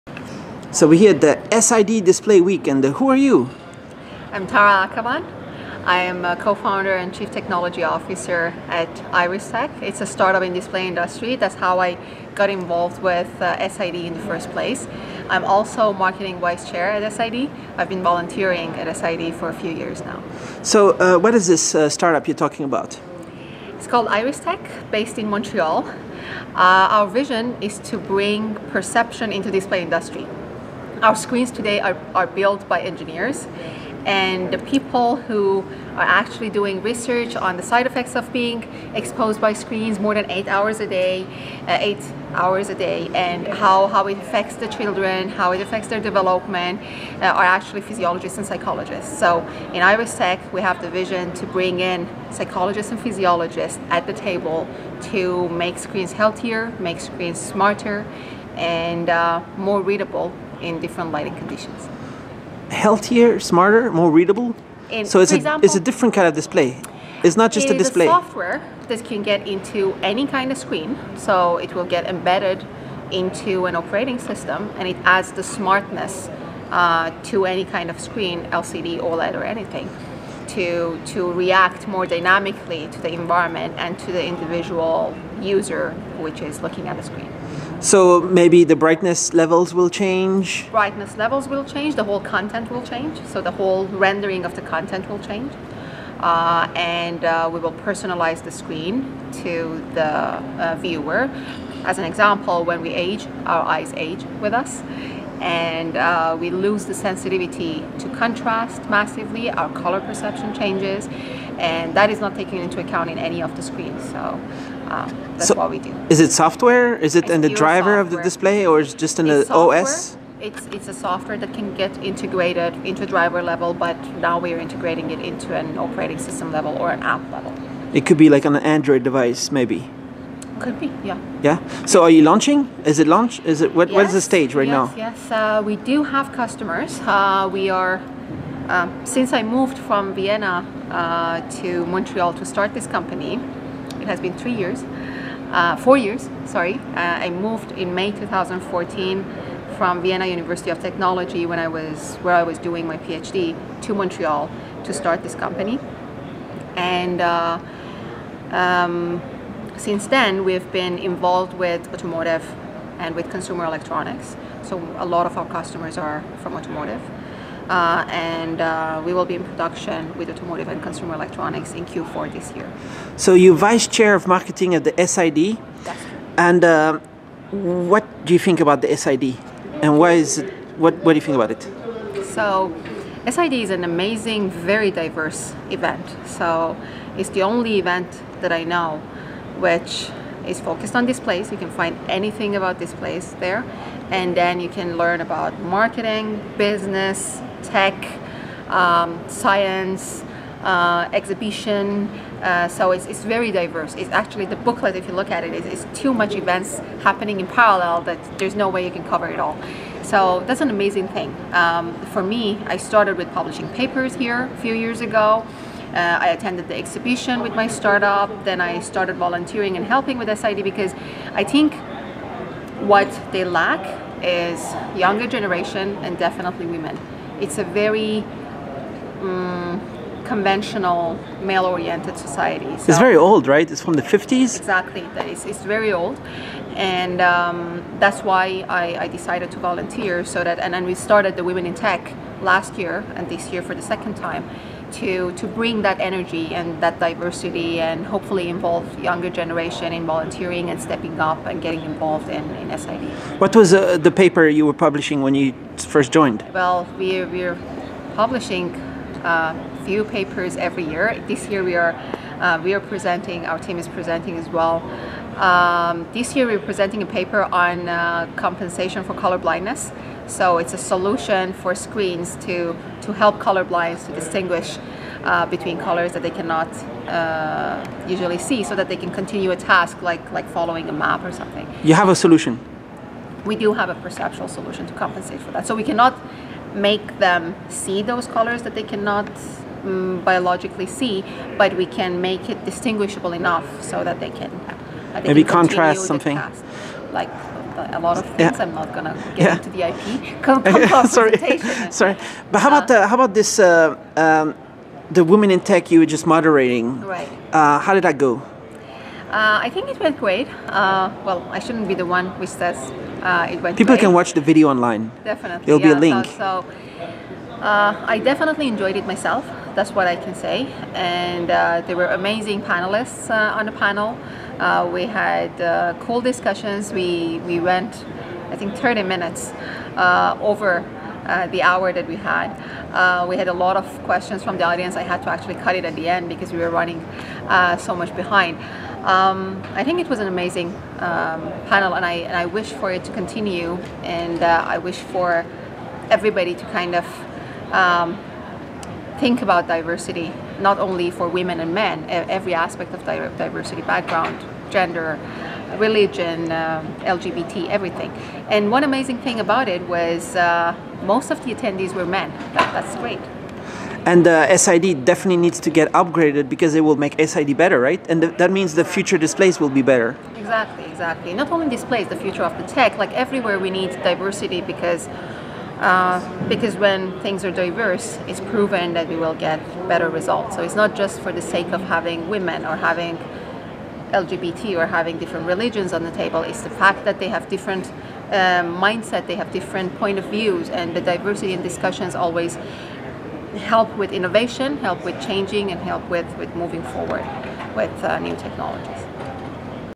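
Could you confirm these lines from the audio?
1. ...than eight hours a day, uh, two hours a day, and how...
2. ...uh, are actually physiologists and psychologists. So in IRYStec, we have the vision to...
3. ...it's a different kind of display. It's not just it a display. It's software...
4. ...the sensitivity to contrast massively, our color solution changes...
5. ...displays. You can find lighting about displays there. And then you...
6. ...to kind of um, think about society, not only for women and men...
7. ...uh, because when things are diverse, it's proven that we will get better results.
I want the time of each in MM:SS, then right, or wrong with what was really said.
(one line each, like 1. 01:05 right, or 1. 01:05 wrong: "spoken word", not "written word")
1. 00:40 wrong: "eight", not "two"
2. 00:47 right
3. 01:05 right
4. 01:46 wrong: "perception", not "solution"
5. 03:11 wrong: "anything", not "lighting"
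6. 05:46 wrong: "diversity", not "society"
7. 06:15 right.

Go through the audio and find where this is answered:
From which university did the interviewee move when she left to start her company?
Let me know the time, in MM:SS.
02:30.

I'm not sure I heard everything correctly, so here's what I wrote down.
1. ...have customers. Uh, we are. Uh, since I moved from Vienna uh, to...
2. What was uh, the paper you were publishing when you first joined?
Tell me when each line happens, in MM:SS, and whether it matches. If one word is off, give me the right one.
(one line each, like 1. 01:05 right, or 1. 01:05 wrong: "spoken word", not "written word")
1. 02:16 right
2. 04:13 right.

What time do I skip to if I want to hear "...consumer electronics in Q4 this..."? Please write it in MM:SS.
02:50.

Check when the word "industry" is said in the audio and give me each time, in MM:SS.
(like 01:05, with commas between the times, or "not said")
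00:10, 00:29.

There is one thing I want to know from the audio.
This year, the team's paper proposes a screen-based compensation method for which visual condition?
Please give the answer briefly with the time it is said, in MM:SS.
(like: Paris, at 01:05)
Color blindness, at 04:29.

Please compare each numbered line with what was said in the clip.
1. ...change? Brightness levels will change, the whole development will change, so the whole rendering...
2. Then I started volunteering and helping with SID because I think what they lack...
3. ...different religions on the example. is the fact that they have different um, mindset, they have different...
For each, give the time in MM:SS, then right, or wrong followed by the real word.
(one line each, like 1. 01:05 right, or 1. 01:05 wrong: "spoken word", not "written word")
1. 01:29 wrong: "content", not "development"
2. 03:38 right
3. 06:25 wrong: "table", not "example".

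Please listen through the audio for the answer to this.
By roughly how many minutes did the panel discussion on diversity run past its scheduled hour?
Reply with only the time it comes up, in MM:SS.
05:28.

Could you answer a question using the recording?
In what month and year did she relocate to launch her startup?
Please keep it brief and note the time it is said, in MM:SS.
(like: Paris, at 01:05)
May 2014, at 02:27.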